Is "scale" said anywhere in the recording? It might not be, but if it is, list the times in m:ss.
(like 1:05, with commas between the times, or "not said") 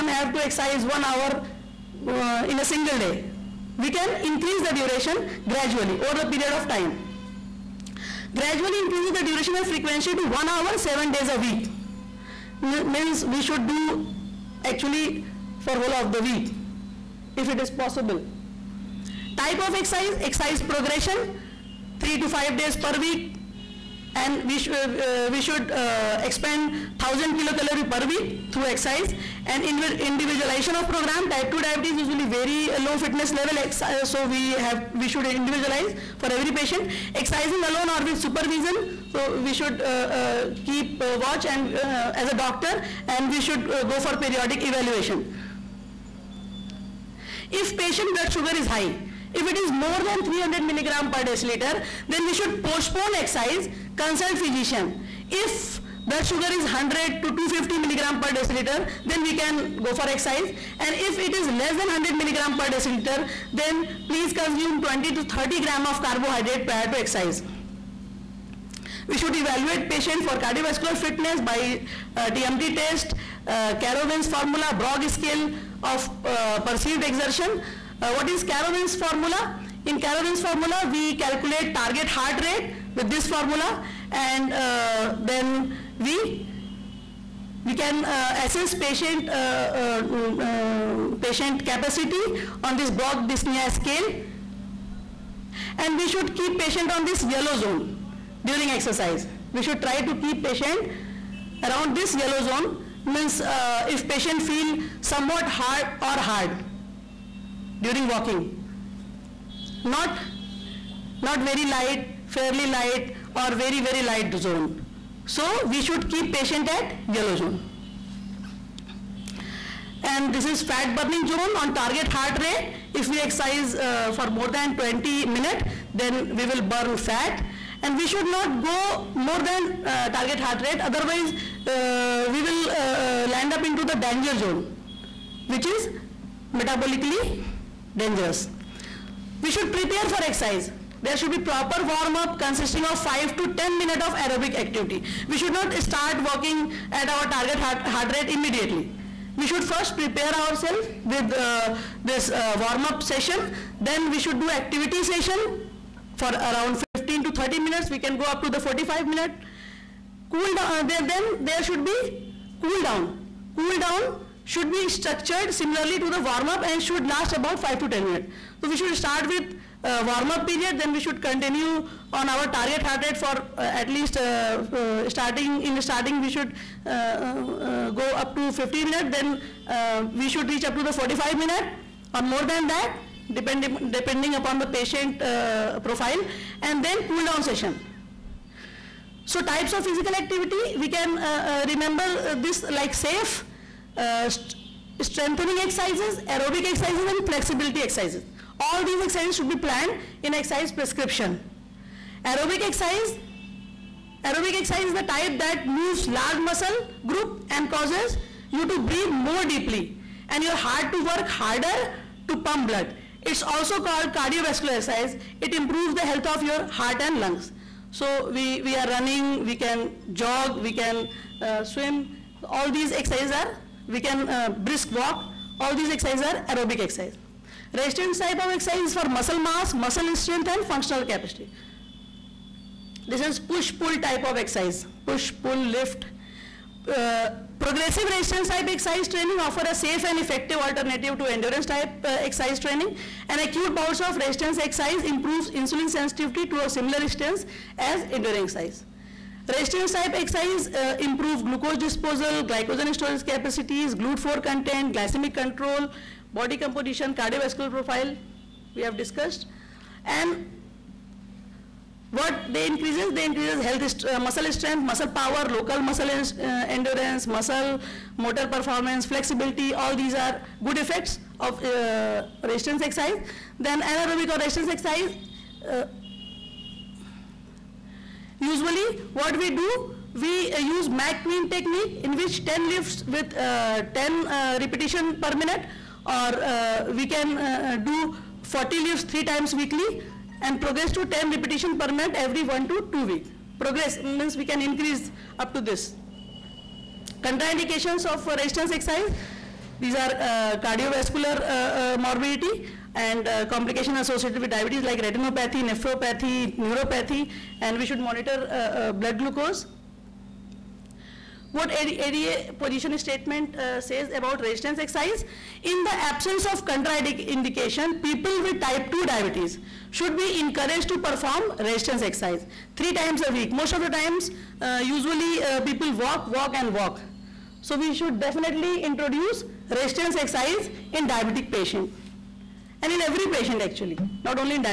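1:15, 1:33.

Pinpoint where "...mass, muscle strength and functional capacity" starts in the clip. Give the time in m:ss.
3:49.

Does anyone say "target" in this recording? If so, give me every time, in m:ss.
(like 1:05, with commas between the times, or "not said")
1:21, 2:01, 2:10, 2:27, 2:52.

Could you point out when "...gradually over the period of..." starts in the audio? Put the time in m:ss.
0:05.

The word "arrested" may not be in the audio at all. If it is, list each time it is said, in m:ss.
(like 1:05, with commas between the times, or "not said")
not said.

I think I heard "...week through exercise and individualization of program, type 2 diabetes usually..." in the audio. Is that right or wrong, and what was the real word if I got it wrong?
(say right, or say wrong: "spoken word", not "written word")
right.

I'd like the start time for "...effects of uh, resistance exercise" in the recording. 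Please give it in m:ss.
4:30.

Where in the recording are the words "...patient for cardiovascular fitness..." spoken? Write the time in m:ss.
1:09.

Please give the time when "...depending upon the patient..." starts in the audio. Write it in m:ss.
3:03.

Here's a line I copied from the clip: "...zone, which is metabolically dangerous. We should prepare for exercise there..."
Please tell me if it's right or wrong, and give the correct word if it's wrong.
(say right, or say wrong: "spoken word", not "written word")
right.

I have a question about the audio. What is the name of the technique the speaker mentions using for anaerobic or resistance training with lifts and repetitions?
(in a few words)
McQueen technique.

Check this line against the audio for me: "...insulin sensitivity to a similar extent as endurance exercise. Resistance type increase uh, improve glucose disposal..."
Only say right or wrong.
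wrong.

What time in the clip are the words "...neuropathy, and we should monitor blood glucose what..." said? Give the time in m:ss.
5:06.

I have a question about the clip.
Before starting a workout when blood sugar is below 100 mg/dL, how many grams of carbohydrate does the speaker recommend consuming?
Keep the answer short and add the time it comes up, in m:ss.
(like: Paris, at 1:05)
20 to 30 grams, at 1:04.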